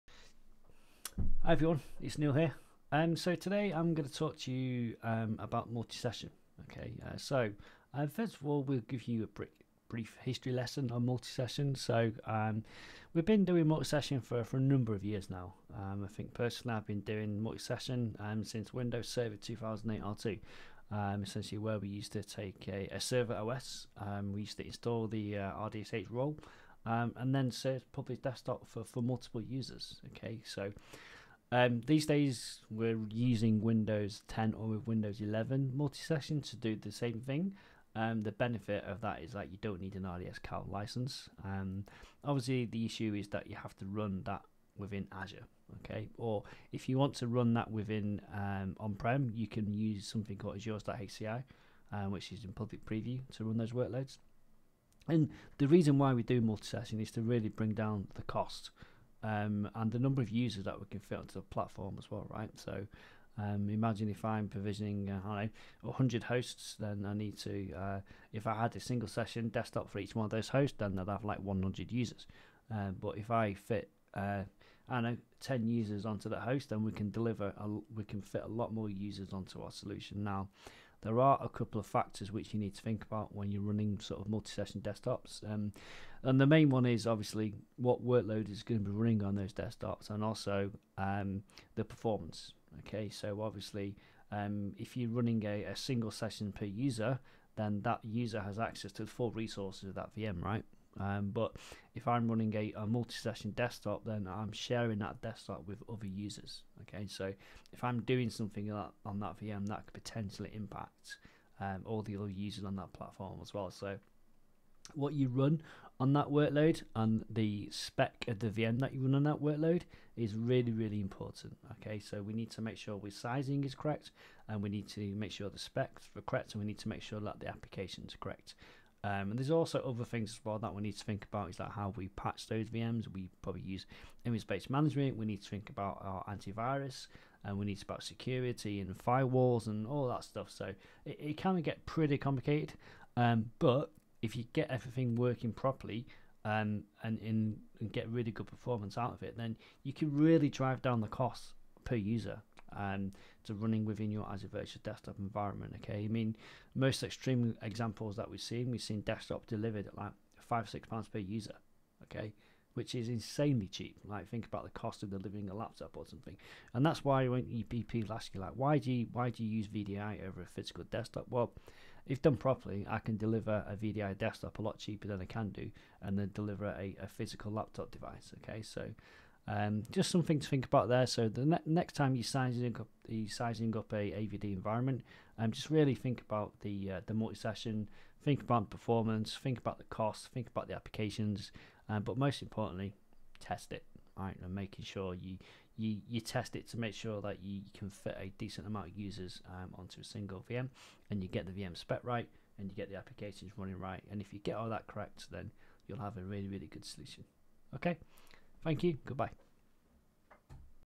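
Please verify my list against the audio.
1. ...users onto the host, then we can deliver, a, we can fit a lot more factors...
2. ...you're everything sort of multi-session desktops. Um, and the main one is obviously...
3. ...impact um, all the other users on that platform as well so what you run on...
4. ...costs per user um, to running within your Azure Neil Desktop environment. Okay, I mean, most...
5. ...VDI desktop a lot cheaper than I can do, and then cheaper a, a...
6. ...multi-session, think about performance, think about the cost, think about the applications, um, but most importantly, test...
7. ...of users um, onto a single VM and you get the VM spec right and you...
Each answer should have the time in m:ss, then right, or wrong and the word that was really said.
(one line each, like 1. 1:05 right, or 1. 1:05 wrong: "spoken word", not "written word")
1. 1:15 wrong: "users", not "factors"
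2. 1:23 wrong: "running", not "everything"
3. 1:50 right
4. 2:31 wrong: "Virtual", not "Neil"
5. 2:53 wrong: "deliver", not "cheaper"
6. 3:07 right
7. 3:18 right.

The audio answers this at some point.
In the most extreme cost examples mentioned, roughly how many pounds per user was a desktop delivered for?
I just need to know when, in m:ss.
2:40.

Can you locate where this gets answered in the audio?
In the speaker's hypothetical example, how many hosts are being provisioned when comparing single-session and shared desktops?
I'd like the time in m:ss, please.
1:05.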